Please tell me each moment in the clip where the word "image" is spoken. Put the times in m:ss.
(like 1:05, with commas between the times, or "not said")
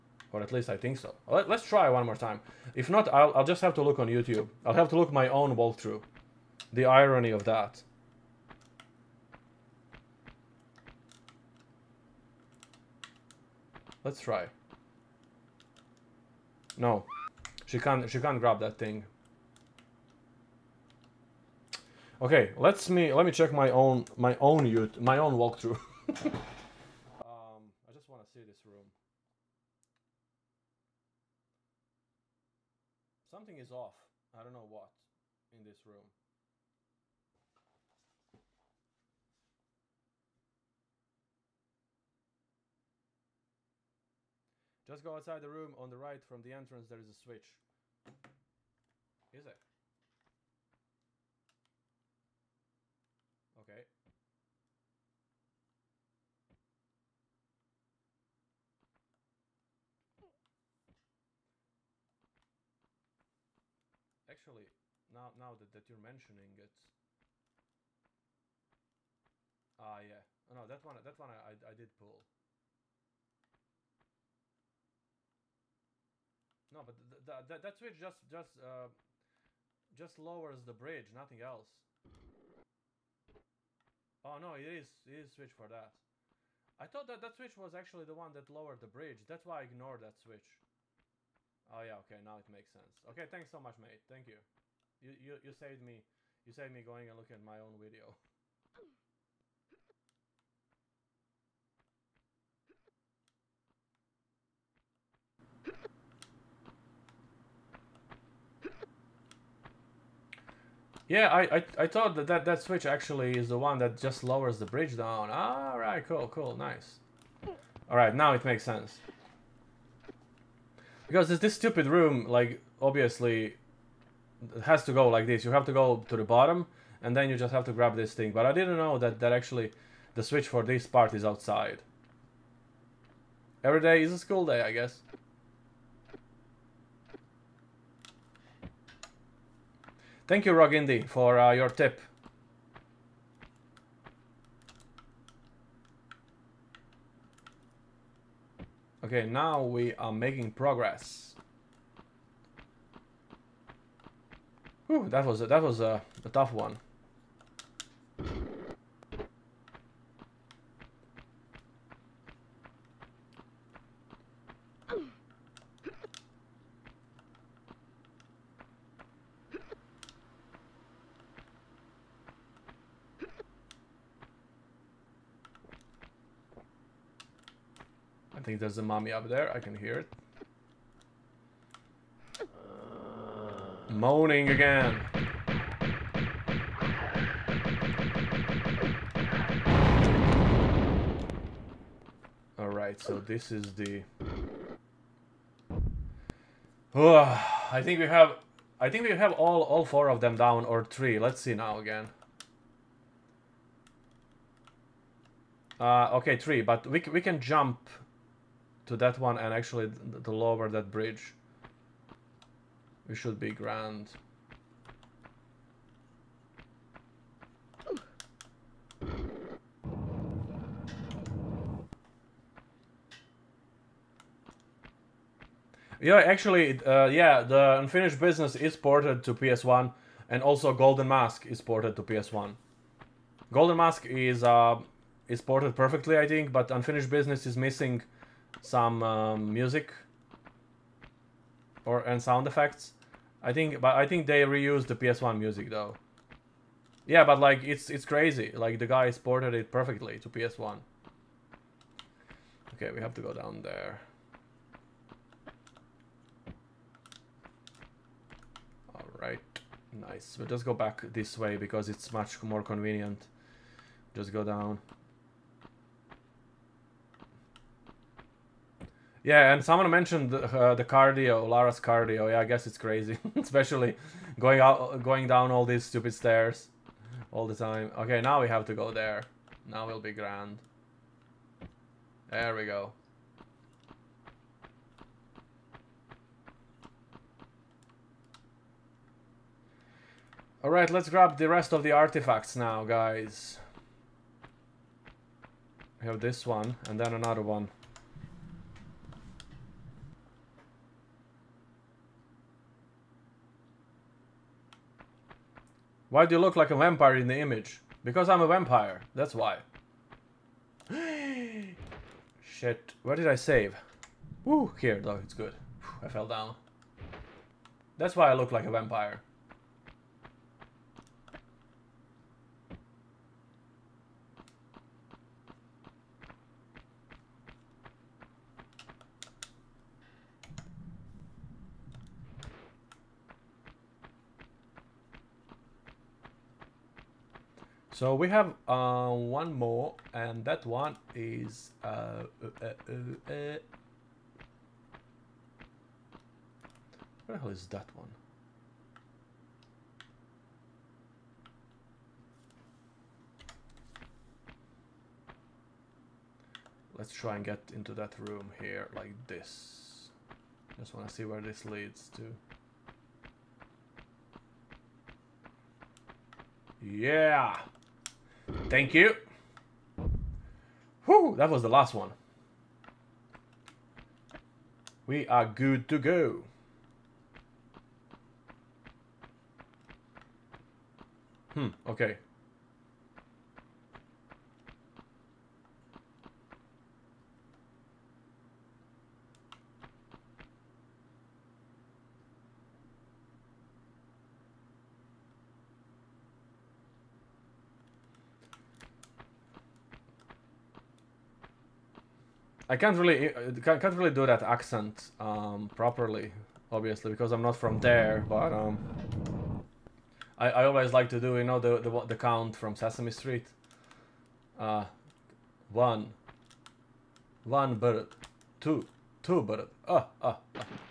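5:07.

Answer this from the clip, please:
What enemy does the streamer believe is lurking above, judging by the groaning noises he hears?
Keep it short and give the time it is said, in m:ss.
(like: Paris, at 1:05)
mummy, at 2:58.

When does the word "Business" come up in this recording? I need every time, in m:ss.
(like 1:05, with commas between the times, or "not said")
3:48, 3:57.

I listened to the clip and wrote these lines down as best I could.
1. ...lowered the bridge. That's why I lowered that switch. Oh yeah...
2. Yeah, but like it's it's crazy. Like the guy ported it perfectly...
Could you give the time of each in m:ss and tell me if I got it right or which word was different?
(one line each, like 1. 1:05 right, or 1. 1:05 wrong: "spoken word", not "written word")
1. 1:28 wrong: "ignored", not "lowered"
2. 4:07 right.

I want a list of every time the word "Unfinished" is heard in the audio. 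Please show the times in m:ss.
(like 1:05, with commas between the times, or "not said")
3:47, 3:56.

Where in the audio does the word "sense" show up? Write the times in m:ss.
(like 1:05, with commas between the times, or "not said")
1:32, 1:58.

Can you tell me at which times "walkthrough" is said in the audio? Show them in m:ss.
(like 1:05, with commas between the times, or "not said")
0:05, 0:25.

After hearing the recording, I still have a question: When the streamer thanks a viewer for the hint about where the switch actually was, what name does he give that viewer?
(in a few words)
Rogindy.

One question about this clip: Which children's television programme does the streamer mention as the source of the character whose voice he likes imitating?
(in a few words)
Sesame Street.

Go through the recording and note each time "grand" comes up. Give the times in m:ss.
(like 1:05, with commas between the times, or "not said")
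3:33, 4:40.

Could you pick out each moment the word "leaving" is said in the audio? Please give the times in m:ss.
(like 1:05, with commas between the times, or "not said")
not said.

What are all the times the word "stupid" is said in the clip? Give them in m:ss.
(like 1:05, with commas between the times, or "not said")
2:01, 4:35.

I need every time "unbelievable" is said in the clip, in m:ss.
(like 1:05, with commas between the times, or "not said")
not said.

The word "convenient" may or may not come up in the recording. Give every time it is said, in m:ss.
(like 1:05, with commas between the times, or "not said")
4:22.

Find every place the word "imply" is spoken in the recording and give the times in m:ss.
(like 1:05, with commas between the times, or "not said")
not said.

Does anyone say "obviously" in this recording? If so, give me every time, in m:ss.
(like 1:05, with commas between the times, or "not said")
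2:02, 6:46.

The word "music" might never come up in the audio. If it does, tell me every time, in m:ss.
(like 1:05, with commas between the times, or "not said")
3:59, 4:05.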